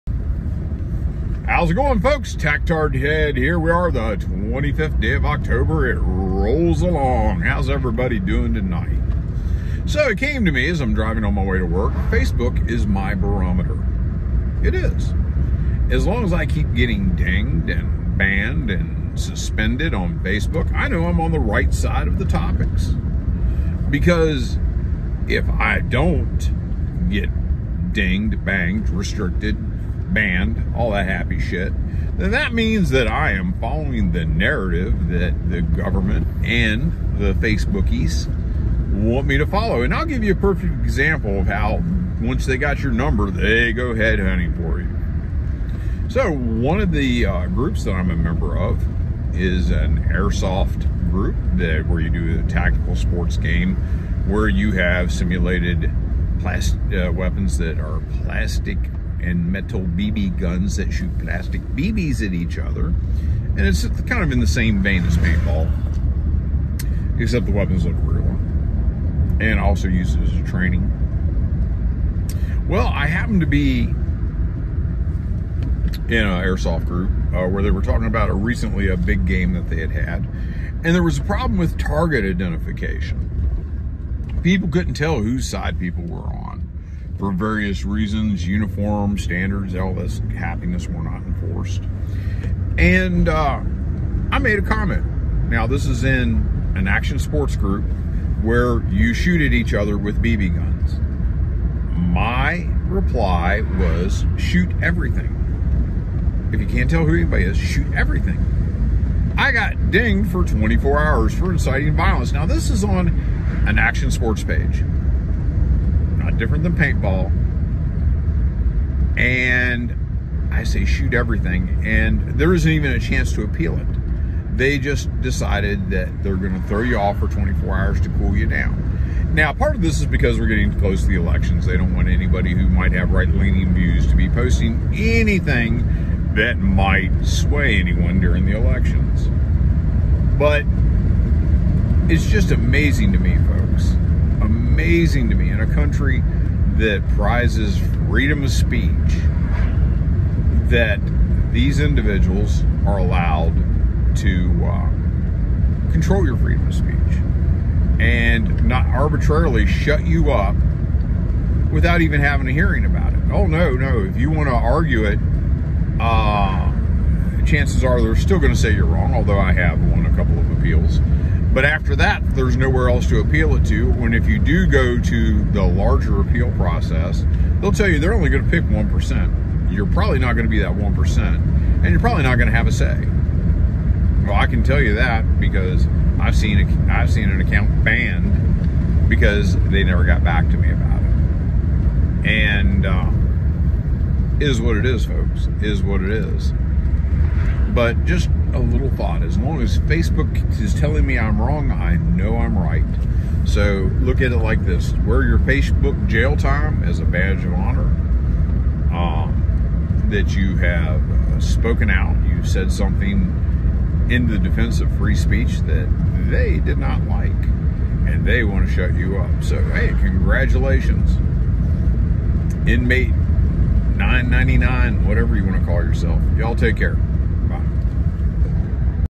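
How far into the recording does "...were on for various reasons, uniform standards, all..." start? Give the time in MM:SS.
01:26.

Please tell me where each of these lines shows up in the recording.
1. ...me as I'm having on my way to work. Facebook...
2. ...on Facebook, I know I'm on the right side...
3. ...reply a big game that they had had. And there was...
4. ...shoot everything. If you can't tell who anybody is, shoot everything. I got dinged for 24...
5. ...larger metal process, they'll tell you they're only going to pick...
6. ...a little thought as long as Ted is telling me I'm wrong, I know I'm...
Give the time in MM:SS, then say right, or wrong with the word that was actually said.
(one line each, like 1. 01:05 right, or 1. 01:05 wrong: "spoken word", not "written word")
1. 00:10 wrong: "driving", not "having"
2. 00:19 right
3. 01:18 wrong: "recently", not "reply"
4. 01:44 right
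5. 02:55 wrong: "appeal", not "metal"
6. 03:18 wrong: "Facebook", not "Ted".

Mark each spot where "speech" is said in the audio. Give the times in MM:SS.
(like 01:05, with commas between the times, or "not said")
02:28, 02:36, 03:35.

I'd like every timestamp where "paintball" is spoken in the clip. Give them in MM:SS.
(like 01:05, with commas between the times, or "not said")
01:05, 01:56.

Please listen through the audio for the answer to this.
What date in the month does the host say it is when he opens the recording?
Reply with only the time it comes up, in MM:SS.
00:04.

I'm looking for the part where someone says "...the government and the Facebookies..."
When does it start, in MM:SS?
00:35.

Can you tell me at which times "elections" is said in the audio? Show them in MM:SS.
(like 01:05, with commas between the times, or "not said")
02:11, 02:18.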